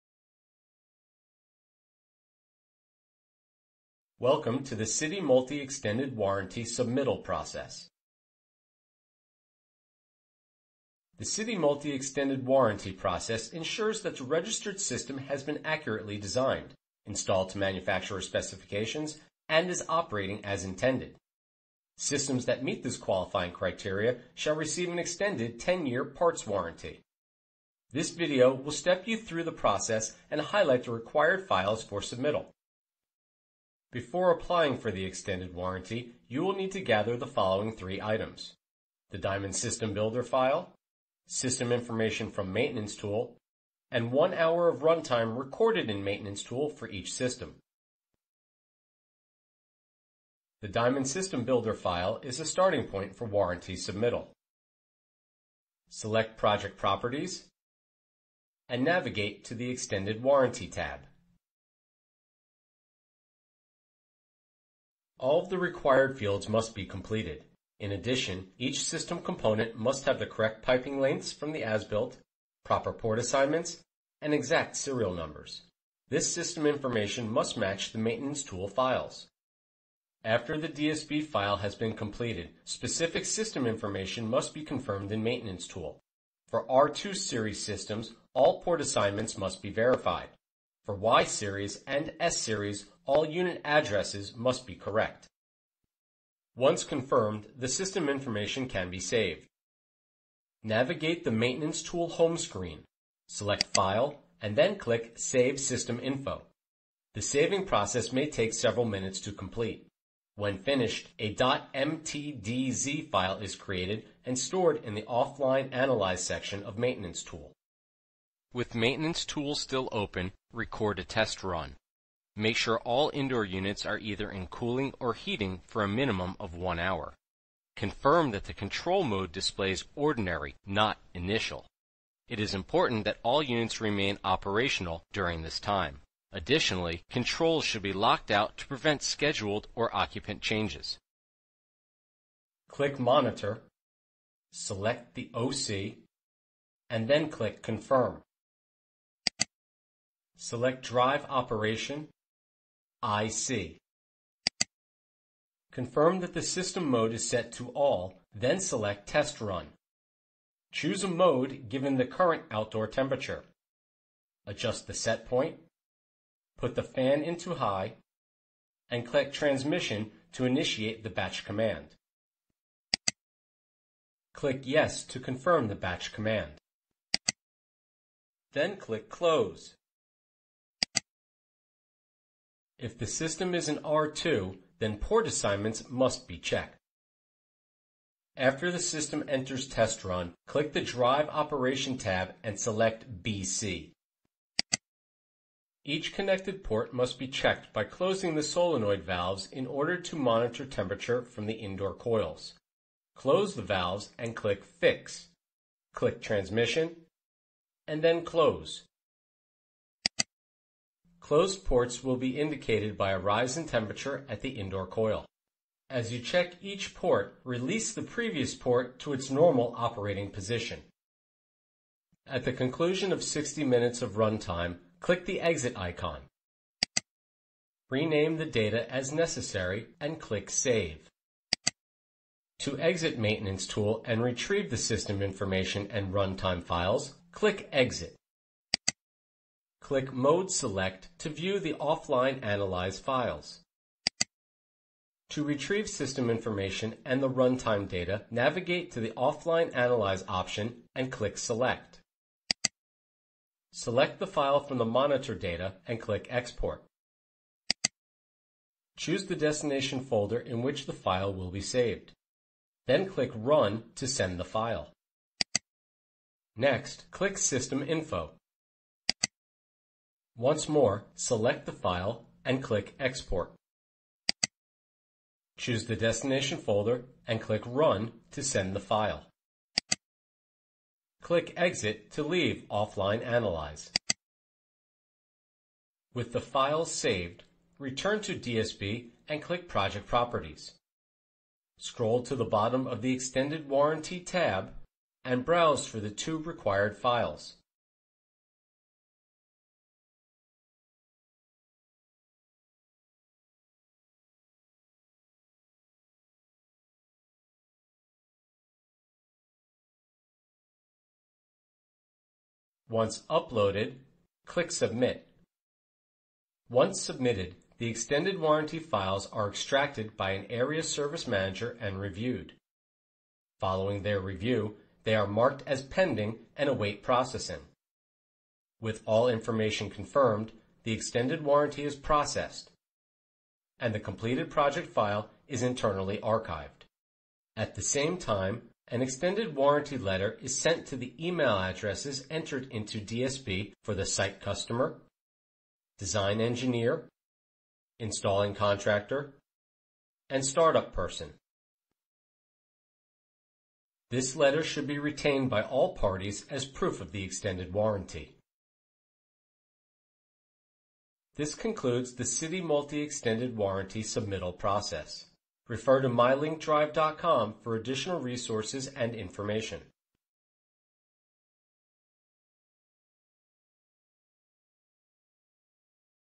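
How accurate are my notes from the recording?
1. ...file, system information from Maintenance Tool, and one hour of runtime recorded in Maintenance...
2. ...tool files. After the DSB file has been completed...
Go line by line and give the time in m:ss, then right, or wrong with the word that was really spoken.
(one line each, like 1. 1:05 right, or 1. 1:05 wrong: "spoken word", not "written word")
1. 0:40 right
2. 1:18 right.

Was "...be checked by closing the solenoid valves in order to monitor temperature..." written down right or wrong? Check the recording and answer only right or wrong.
right.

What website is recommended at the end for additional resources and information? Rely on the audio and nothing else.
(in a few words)
mylinkdrive.com.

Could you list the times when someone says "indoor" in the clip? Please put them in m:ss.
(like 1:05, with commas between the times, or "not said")
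2:03, 3:21, 3:34.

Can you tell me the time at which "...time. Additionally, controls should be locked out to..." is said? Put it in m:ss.
2:15.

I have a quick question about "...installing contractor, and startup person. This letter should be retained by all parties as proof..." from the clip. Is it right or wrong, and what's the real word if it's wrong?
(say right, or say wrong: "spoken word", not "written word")
right.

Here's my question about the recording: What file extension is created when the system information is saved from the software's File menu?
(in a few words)
.mtdz.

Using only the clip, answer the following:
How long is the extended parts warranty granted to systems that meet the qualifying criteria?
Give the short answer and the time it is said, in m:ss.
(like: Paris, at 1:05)
10-year, at 0:25.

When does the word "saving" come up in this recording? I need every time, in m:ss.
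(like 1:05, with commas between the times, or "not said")
1:47.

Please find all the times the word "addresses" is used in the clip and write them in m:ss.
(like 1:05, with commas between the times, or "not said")
1:33, 5:41.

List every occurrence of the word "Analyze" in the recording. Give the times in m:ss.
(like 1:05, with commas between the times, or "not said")
1:55, 4:02, 4:09, 4:43.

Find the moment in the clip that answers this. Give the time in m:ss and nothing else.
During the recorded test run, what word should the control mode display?
2:09.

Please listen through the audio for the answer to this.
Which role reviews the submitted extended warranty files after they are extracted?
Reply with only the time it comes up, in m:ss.
5:20.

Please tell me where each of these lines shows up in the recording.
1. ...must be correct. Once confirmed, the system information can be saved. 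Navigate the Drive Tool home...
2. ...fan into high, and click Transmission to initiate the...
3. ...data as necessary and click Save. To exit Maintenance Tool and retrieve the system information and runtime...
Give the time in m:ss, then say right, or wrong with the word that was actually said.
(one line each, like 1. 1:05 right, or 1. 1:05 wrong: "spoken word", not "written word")
1. 1:34 wrong: "Maintenance", not "Drive"
2. 2:46 right
3. 3:48 right.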